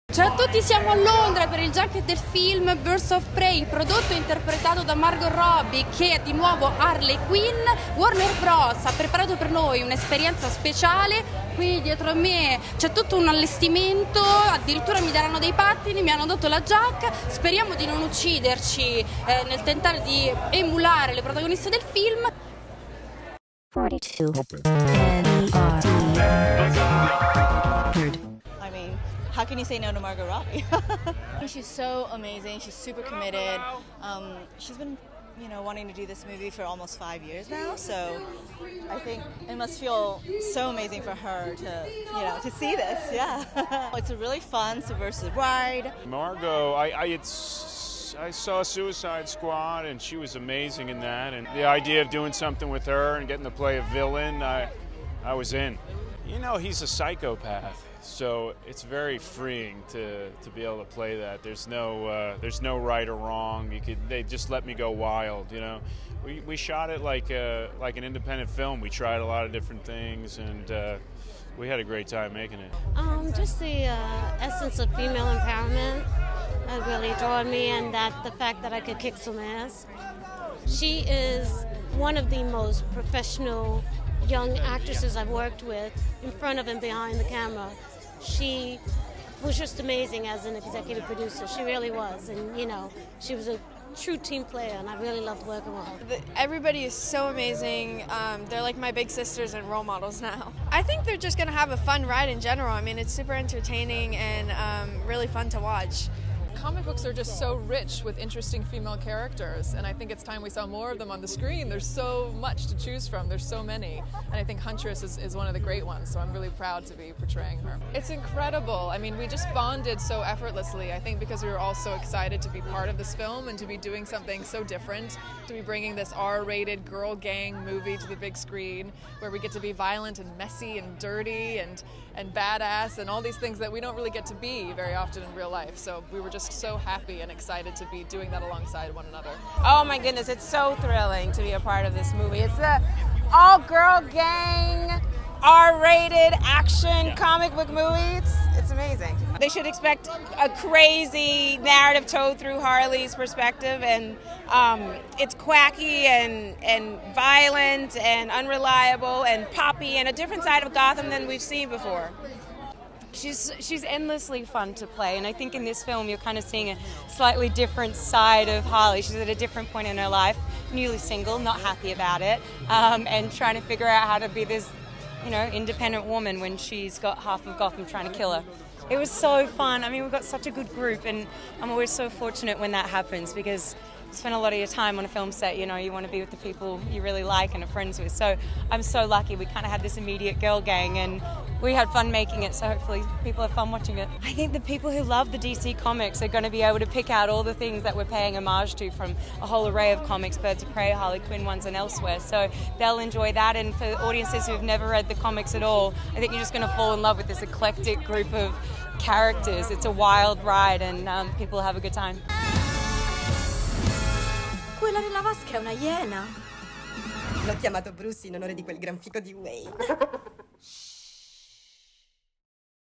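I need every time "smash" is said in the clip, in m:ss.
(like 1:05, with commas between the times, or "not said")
not said.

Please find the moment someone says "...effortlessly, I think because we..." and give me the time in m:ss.
2:00.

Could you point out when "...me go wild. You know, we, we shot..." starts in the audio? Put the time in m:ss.
1:04.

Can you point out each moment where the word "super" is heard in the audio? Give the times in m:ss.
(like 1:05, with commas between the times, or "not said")
0:32, 1:43.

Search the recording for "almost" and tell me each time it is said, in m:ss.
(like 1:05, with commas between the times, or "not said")
0:36.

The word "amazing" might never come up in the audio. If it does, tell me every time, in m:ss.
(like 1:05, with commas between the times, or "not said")
0:32, 0:40, 0:50, 1:29, 1:37, 2:28.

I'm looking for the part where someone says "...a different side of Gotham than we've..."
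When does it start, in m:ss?
2:40.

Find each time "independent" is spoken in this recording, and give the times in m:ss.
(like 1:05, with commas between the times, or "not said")
1:08, 2:55.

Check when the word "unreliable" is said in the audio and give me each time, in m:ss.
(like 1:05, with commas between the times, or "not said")
2:38.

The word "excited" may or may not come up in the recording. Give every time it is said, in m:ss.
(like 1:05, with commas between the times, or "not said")
2:01, 2:17.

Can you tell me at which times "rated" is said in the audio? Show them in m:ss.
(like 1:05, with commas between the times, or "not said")
2:06, 2:25.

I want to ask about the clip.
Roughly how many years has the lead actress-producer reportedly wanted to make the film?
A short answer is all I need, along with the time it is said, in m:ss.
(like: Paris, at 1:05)
5, at 0:36.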